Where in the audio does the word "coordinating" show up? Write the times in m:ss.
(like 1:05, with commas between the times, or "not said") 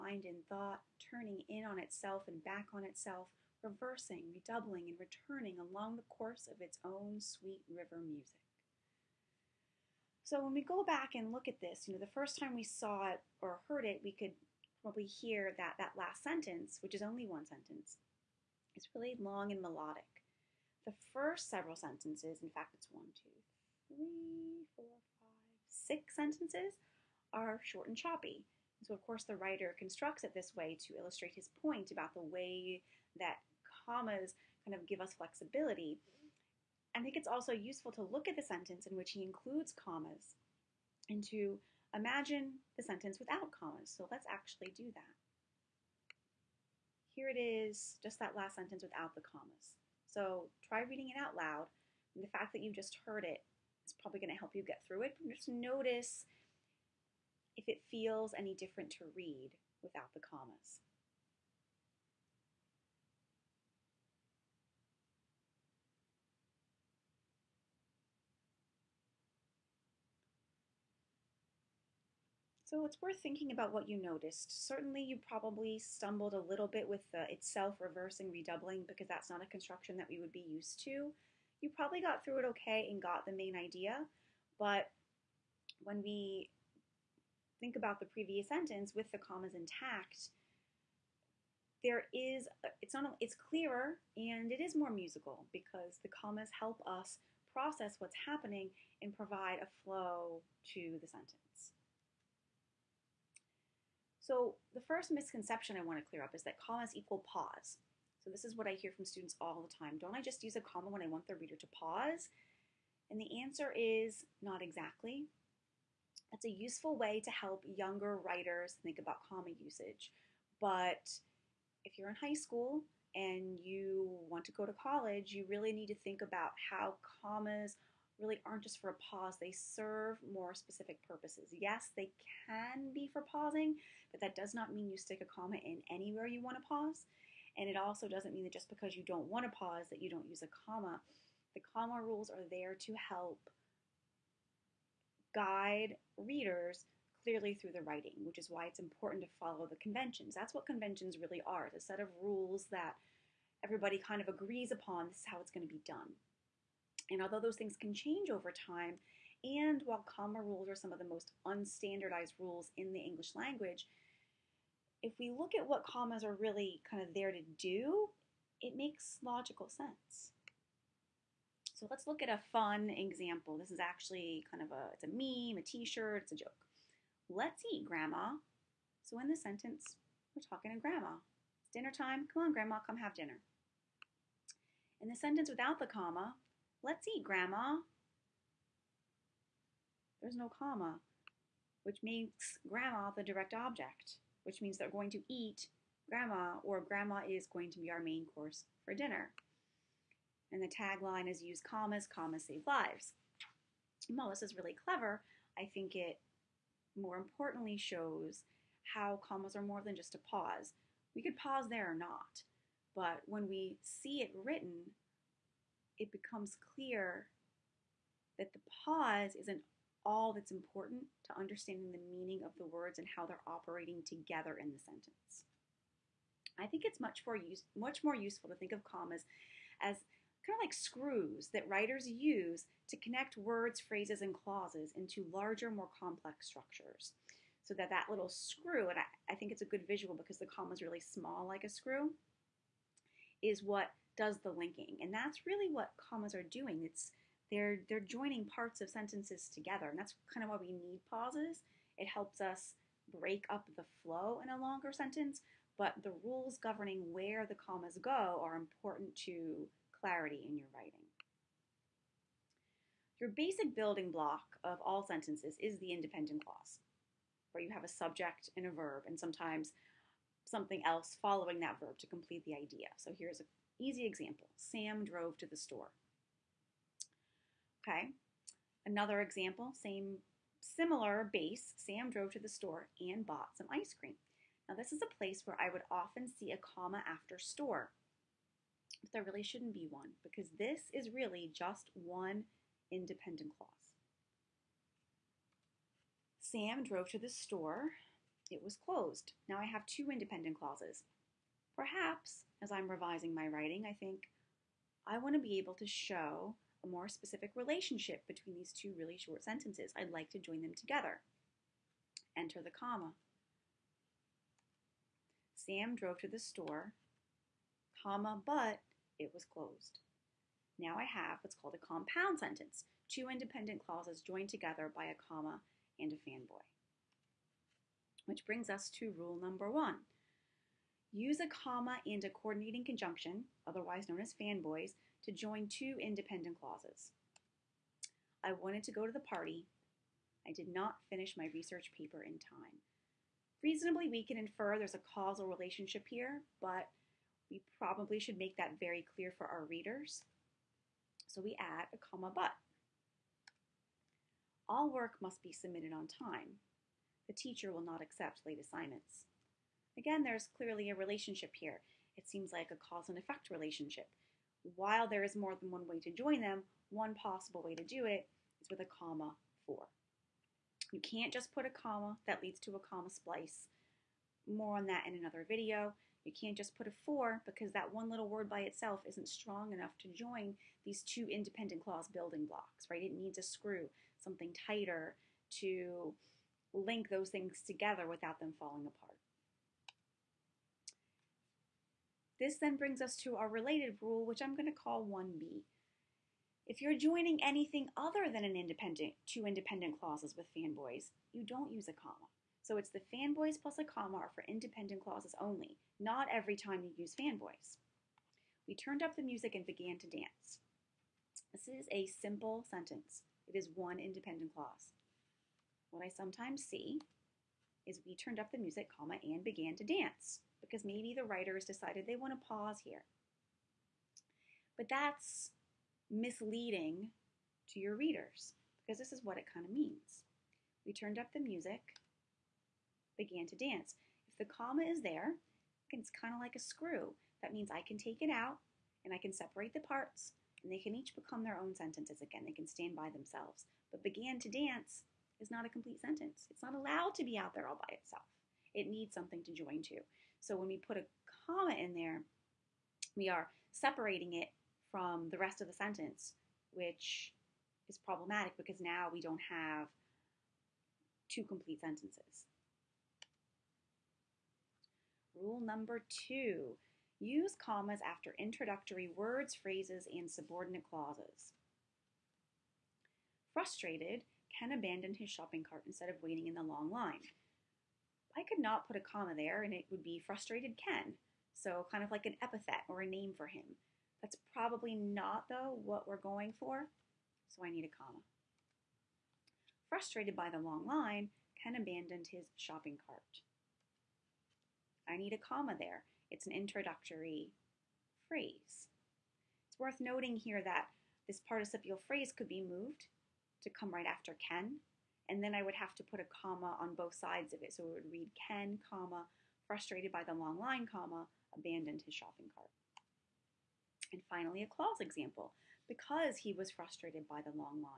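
5:32.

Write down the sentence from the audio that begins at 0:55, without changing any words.
just notice if it feels any different to read without the commas.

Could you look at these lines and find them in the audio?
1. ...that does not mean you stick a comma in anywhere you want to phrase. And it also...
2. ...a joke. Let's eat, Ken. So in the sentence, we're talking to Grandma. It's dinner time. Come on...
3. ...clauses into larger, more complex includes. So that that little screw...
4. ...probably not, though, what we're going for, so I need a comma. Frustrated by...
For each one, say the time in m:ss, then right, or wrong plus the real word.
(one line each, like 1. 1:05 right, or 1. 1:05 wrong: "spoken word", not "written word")
1. 2:14 wrong: "pause", not "phrase"
2. 2:56 wrong: "Grandma", not "Ken"
3. 3:54 wrong: "structures", not "includes"
4. 8:04 right.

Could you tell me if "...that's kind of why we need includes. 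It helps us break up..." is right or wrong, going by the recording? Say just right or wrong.
wrong.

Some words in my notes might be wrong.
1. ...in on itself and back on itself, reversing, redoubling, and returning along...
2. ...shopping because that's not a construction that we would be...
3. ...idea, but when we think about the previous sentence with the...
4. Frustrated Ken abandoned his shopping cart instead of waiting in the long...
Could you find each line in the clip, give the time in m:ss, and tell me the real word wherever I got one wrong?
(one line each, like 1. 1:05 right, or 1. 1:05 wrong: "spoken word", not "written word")
1. 0:01 right
2. 1:18 wrong: "redoubling", not "shopping"
3. 1:23 right
4. 7:53 right.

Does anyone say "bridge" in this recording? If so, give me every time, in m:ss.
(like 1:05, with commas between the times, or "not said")
not said.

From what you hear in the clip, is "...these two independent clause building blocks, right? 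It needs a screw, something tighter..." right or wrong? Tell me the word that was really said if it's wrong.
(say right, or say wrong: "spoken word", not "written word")
right.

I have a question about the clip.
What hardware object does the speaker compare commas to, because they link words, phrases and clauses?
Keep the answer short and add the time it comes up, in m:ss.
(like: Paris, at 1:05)
screws, at 3:50.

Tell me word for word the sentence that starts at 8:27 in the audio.
So it would read Ken, comma, frustrated by the long line, comma, abandoned his shopping cart.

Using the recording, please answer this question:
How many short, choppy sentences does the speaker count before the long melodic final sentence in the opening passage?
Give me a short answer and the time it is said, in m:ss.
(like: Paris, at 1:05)
6, at 0:25.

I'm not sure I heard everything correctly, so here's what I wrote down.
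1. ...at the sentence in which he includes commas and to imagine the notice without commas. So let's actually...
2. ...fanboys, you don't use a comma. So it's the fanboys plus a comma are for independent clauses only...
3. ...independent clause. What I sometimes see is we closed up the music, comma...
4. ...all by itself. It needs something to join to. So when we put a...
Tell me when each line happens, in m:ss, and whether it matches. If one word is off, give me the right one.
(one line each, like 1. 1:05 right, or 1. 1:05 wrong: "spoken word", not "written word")
1. 0:38 wrong: "sentence", not "notice"
2. 6:40 right
3. 6:53 wrong: "turned", not "closed"
4. 7:27 right.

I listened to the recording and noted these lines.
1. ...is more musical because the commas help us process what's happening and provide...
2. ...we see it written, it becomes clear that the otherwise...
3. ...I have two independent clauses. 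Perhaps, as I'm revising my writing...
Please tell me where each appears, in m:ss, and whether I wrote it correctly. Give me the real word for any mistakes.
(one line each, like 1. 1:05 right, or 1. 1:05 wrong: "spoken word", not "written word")
1. 1:34 right
2. 3:33 wrong: "pause", not "otherwise"
3. 4:59 right.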